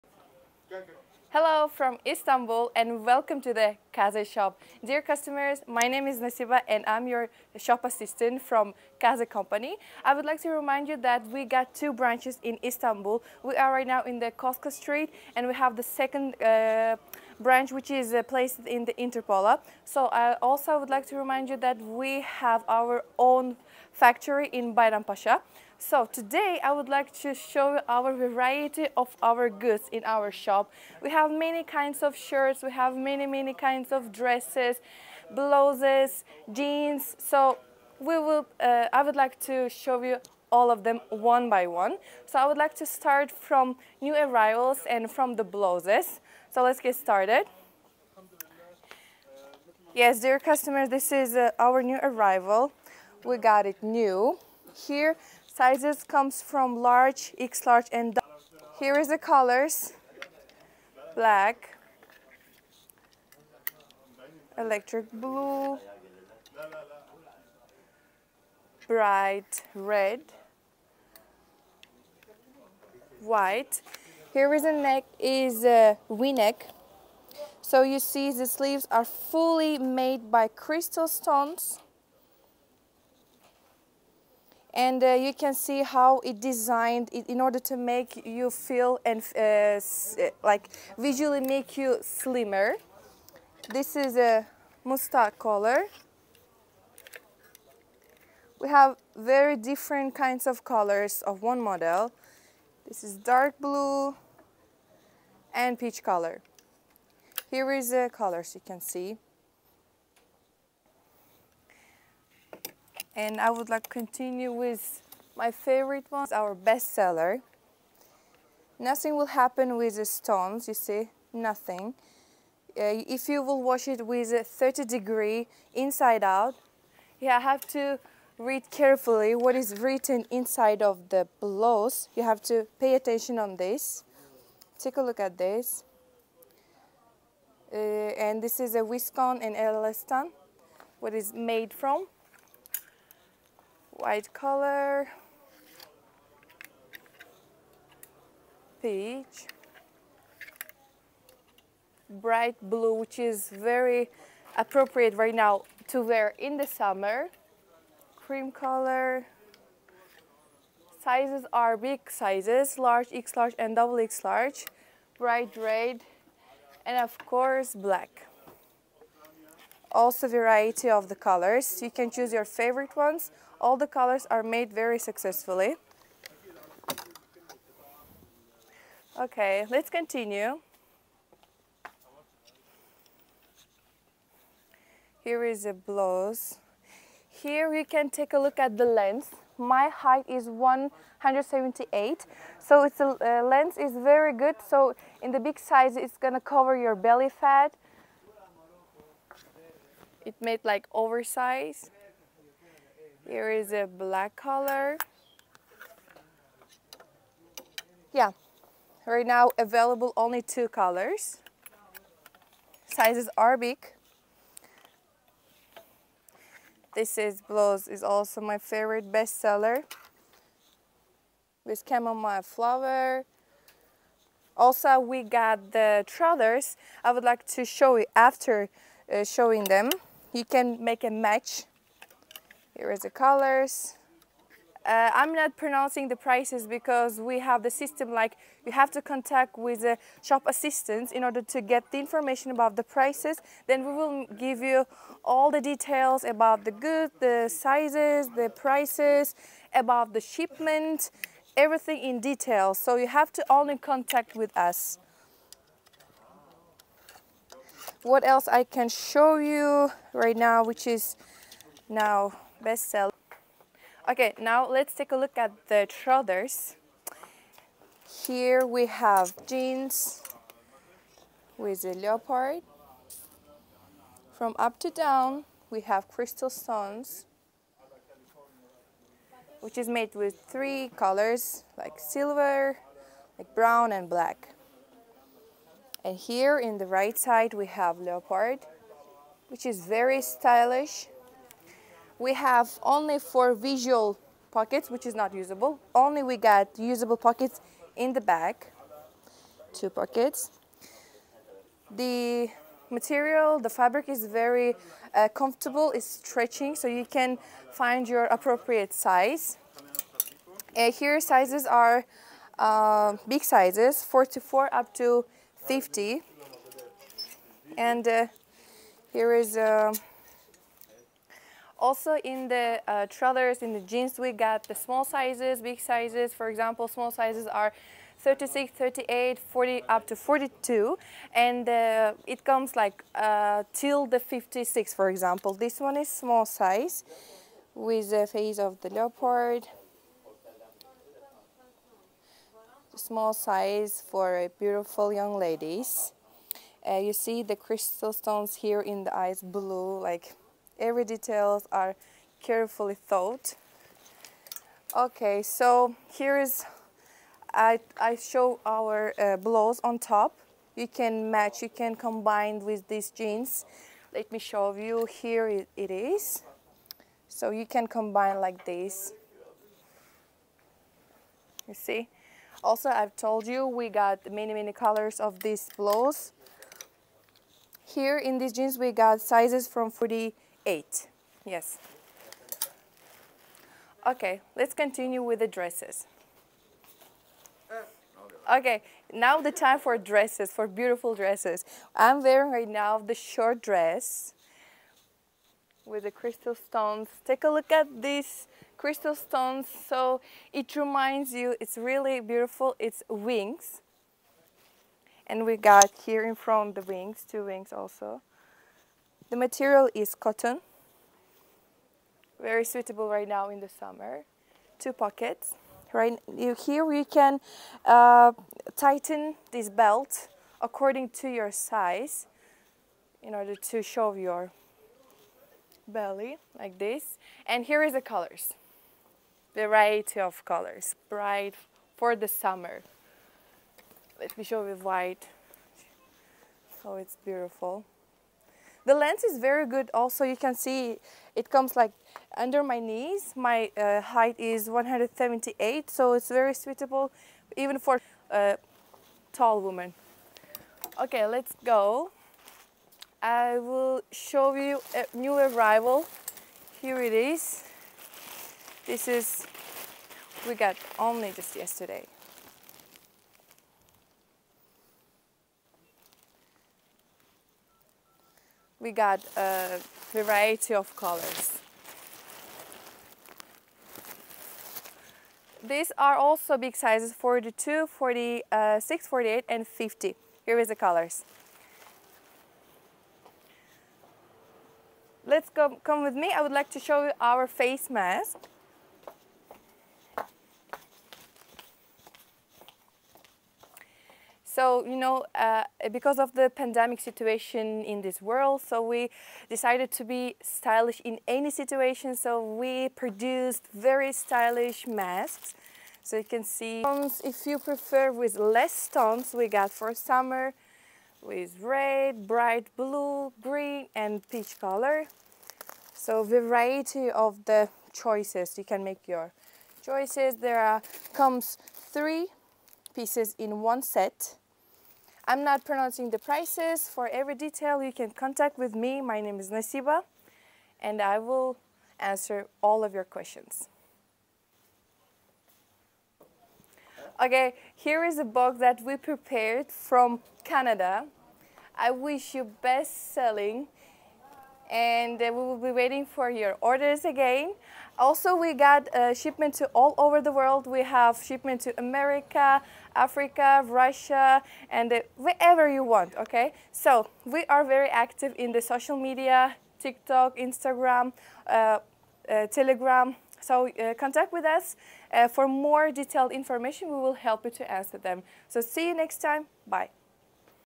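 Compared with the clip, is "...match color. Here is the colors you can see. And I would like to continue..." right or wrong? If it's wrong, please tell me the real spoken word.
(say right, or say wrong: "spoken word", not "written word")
wrong: "peach", not "match".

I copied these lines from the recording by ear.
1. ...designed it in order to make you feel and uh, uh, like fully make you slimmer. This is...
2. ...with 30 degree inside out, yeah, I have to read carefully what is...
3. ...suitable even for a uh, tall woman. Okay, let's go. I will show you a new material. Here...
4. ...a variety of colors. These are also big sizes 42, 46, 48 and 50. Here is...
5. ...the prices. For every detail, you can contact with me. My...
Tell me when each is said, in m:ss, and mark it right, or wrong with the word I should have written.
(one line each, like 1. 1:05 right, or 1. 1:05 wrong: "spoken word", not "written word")
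1. 1:26 wrong: "visually", not "fully"
2. 2:04 right
3. 7:26 wrong: "arrival", not "material"
4. 7:49 right
5. 8:46 right.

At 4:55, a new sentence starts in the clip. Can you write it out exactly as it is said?
Only we got usable pockets in the back, two pockets.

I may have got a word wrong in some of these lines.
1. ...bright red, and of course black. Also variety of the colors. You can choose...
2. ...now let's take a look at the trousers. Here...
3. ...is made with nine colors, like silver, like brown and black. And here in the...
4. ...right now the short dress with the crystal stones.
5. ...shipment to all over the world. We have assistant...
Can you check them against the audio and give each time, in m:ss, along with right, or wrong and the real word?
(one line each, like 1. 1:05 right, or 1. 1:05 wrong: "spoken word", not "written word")
1. 2:45 right
2. 4:24 right
3. 4:39 wrong: "three", not "nine"
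4. 6:32 right
5. 9:09 wrong: "shipment", not "assistant".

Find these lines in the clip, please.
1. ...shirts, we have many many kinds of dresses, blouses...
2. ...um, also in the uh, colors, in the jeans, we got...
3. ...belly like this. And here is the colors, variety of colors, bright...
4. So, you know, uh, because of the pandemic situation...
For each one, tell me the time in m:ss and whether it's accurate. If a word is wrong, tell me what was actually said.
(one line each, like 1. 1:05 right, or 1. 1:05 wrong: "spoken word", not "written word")
1. 0:32 right
2. 5:19 wrong: "trousers", not "colors"
3. 7:05 right
4. 8:14 right.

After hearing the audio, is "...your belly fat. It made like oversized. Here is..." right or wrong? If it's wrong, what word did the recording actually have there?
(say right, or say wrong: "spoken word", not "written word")
right.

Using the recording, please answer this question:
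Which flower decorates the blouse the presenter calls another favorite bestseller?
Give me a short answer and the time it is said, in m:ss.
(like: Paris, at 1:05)
Chamomile, at 3:41.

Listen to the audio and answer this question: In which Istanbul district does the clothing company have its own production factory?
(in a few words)
Bayram Pasha.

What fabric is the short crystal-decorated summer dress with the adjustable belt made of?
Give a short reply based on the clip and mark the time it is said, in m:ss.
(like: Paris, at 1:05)
Cotton, at 6:50.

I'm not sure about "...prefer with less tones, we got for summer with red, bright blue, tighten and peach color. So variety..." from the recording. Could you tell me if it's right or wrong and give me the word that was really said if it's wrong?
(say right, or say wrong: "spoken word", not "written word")
wrong: "green", not "tighten".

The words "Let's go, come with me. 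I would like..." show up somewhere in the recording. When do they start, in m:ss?
8:05.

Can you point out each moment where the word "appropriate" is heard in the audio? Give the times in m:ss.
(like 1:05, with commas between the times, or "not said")
2:34, 5:08.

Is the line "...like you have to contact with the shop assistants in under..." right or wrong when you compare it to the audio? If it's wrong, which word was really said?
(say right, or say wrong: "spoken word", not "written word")
wrong: "order", not "under".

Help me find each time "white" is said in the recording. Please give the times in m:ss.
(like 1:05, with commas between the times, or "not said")
1:13, 2:23, 7:14.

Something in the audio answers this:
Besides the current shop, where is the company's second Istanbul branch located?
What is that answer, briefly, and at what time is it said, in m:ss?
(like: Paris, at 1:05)
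Interpola, at 0:18.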